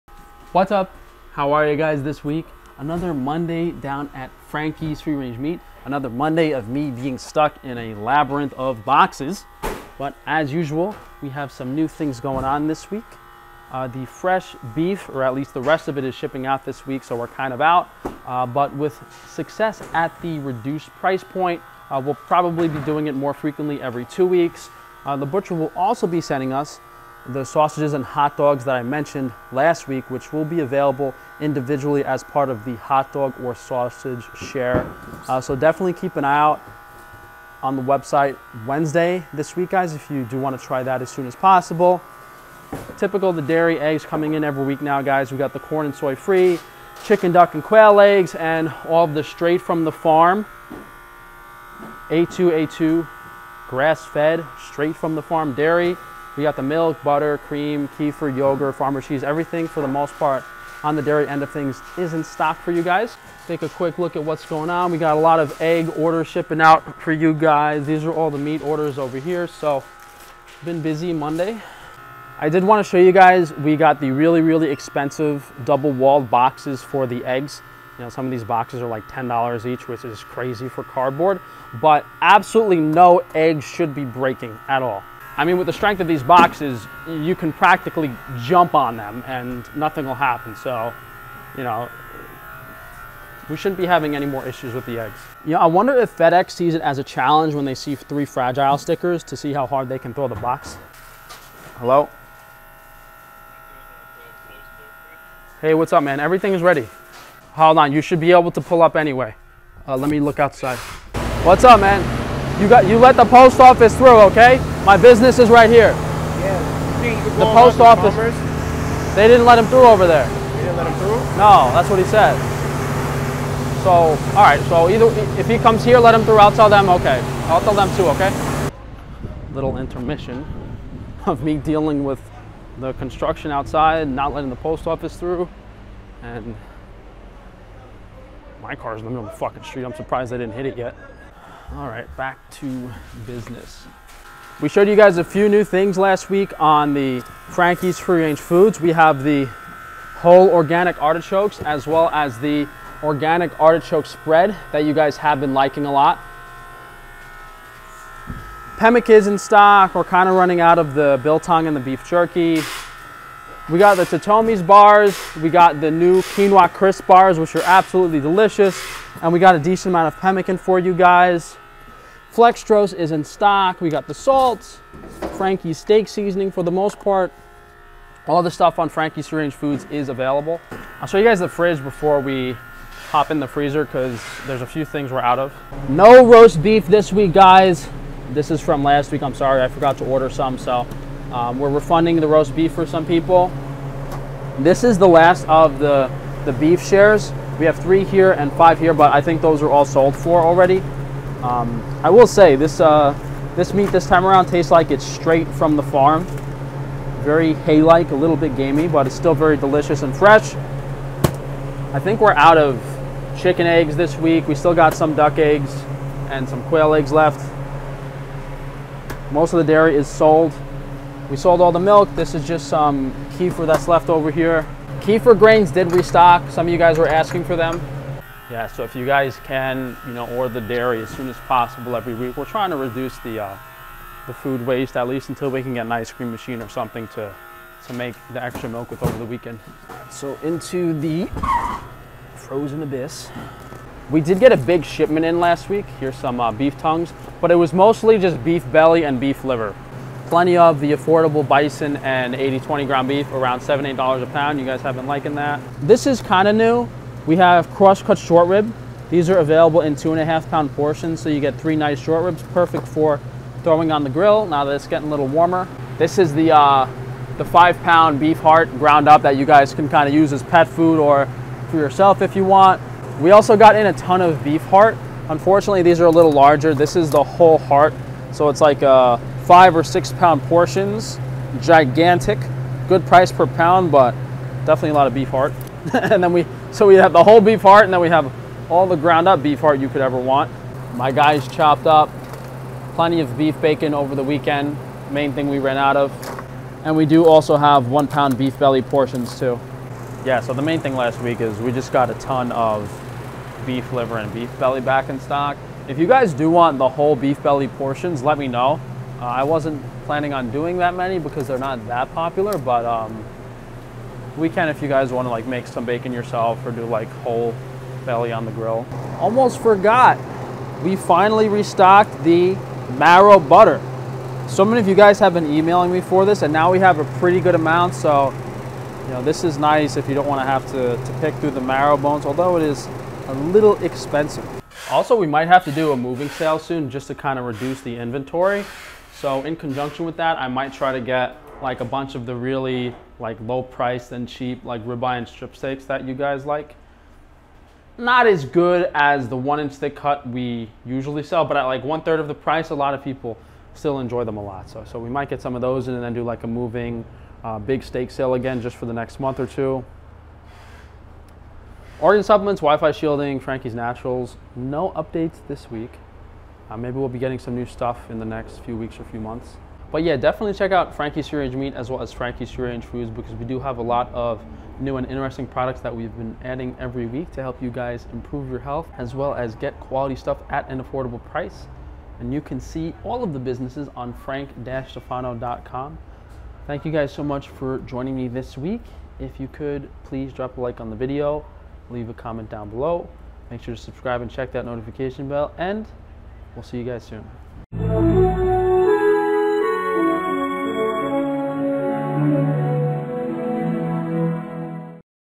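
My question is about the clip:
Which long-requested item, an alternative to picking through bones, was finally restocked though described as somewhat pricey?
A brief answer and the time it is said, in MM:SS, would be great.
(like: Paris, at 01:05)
marrow butter, at 05:22.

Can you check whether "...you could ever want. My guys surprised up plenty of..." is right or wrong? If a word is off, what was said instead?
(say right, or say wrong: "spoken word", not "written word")
wrong: "chopped", not "surprised".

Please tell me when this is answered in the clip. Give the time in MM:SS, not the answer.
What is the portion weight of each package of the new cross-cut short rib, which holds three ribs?
04:19.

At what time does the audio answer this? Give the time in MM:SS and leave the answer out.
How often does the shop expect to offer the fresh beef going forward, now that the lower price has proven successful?
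00:23.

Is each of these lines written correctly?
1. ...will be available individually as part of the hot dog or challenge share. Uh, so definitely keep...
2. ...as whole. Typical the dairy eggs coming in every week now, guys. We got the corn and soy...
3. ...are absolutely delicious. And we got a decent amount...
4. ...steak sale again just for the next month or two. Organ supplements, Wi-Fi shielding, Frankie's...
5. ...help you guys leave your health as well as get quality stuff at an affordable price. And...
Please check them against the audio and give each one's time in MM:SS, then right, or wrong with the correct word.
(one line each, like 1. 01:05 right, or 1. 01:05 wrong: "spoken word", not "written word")
1. 00:30 wrong: "sausage", not "challenge"
2. 00:41 wrong: "possible", not "whole"
3. 02:47 right
4. 05:57 right
5. 06:17 wrong: "improve", not "leave".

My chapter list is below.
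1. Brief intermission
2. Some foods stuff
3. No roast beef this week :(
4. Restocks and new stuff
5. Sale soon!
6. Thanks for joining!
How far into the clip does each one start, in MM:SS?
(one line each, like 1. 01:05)
1. 01:40
2. 02:24
3. 03:05
4. 03:59
5. 05:34
6. 06:09.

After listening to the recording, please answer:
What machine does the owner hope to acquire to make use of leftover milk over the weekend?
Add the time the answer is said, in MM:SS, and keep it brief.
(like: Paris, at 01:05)
ice cream machine, at 03:55.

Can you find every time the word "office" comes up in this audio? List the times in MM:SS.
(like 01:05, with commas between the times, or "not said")
01:53, 01:57, 02:14.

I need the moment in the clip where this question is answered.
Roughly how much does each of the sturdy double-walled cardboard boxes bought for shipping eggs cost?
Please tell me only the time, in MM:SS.
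01:19.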